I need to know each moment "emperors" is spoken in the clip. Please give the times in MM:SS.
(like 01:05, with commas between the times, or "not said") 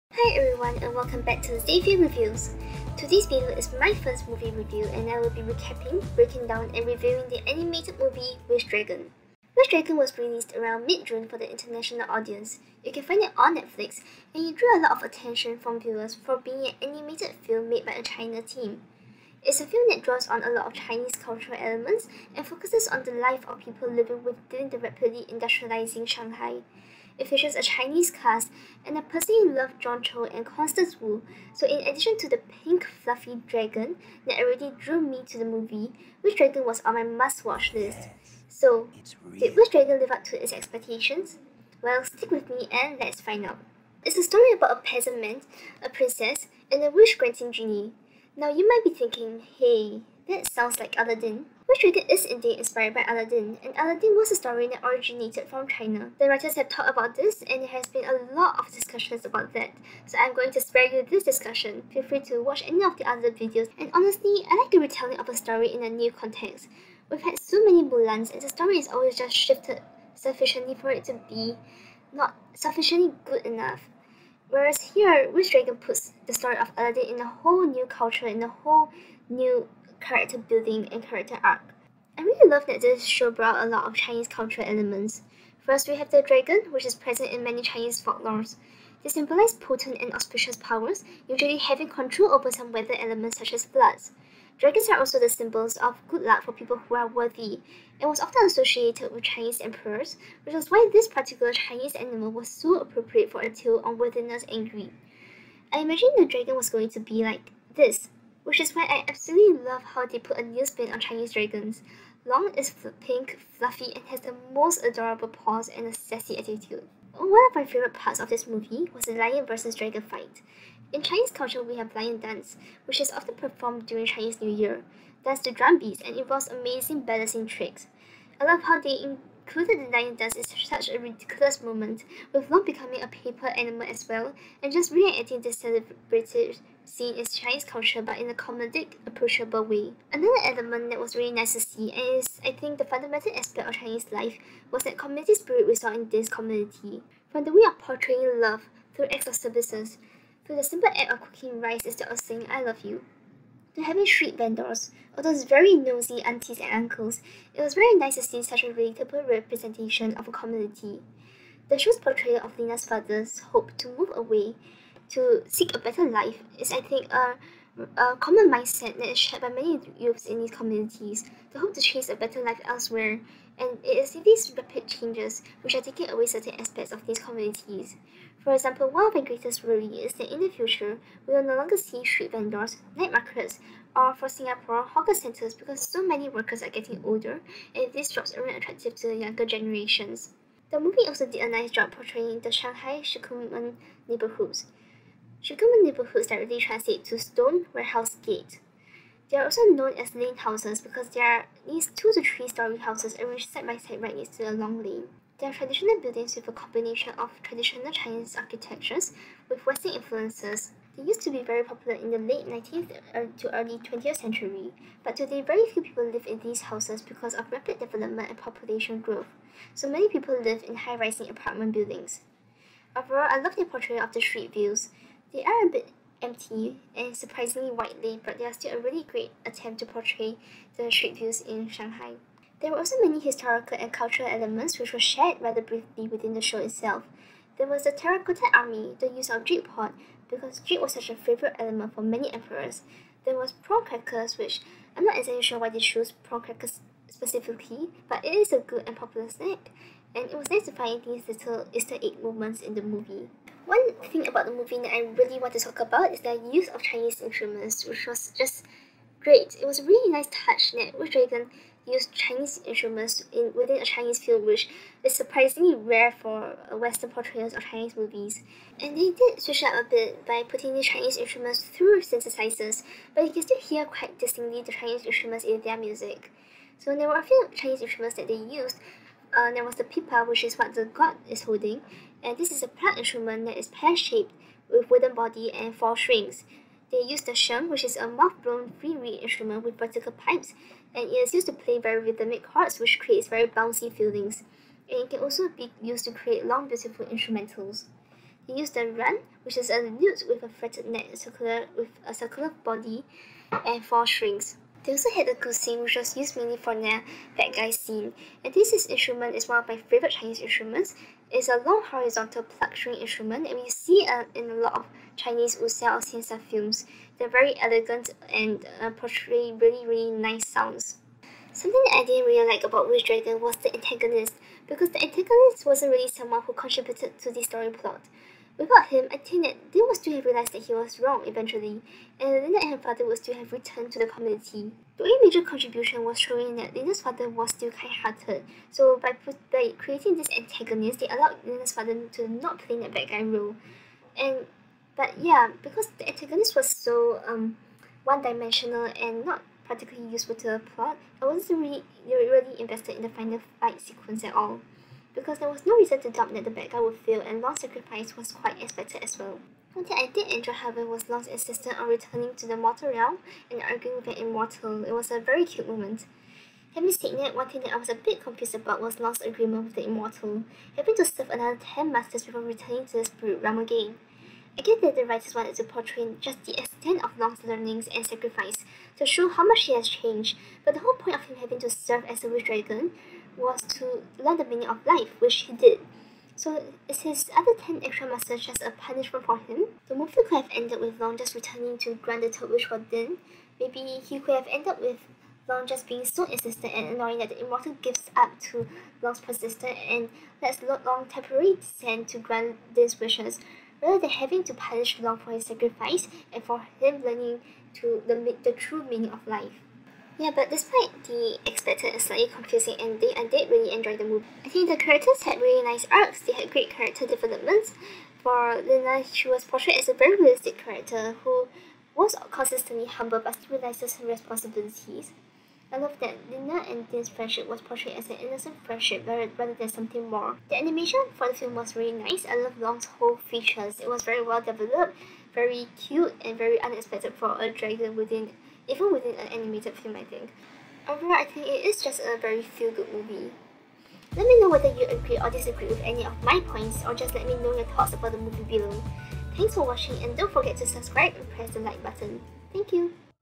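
01:39, 04:02.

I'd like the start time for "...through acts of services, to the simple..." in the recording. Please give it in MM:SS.
02:28.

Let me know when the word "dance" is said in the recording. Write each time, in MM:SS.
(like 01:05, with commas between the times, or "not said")
02:02, 02:10.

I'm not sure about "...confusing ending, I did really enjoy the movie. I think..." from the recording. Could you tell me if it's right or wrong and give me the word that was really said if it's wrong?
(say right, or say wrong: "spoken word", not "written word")
right.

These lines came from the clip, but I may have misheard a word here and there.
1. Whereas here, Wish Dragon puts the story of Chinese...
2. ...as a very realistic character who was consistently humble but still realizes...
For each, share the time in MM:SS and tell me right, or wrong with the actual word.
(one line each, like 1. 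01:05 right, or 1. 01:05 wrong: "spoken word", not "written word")
1. 01:14 wrong: "Aladdin", not "Chinese"
2. 06:59 right.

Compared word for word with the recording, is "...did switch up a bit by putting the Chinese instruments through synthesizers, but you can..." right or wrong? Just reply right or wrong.
right.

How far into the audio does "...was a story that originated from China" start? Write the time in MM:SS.
00:54.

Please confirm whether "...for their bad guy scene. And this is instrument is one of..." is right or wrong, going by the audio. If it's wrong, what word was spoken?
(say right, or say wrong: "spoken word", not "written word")
right.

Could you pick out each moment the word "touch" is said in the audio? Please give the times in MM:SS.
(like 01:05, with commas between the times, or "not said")
04:20.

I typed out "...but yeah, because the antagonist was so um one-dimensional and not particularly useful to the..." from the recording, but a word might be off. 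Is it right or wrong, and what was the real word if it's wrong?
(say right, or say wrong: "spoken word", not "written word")
right.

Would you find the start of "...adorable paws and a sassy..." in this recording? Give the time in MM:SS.
01:54.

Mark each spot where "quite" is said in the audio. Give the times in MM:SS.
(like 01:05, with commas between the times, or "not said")
04:33, 05:58.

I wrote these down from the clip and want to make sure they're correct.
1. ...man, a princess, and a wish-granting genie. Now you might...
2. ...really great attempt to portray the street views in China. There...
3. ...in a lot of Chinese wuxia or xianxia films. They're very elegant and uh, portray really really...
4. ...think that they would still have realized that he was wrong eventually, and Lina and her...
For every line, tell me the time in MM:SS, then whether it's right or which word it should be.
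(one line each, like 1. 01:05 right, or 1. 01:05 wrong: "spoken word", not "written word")
1. 00:45 right
2. 03:48 wrong: "Shanghai", not "China"
3. 05:14 right
4. 05:29 right.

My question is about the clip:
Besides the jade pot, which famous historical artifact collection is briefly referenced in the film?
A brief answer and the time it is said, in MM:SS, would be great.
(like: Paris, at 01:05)
terracotta army, at 03:57.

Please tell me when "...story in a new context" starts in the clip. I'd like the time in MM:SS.
01:05.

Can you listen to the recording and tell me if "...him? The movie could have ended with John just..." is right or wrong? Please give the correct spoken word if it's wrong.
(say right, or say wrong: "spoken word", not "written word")
wrong: "Long", not "John".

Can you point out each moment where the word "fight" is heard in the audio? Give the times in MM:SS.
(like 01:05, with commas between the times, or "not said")
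02:00, 05:53.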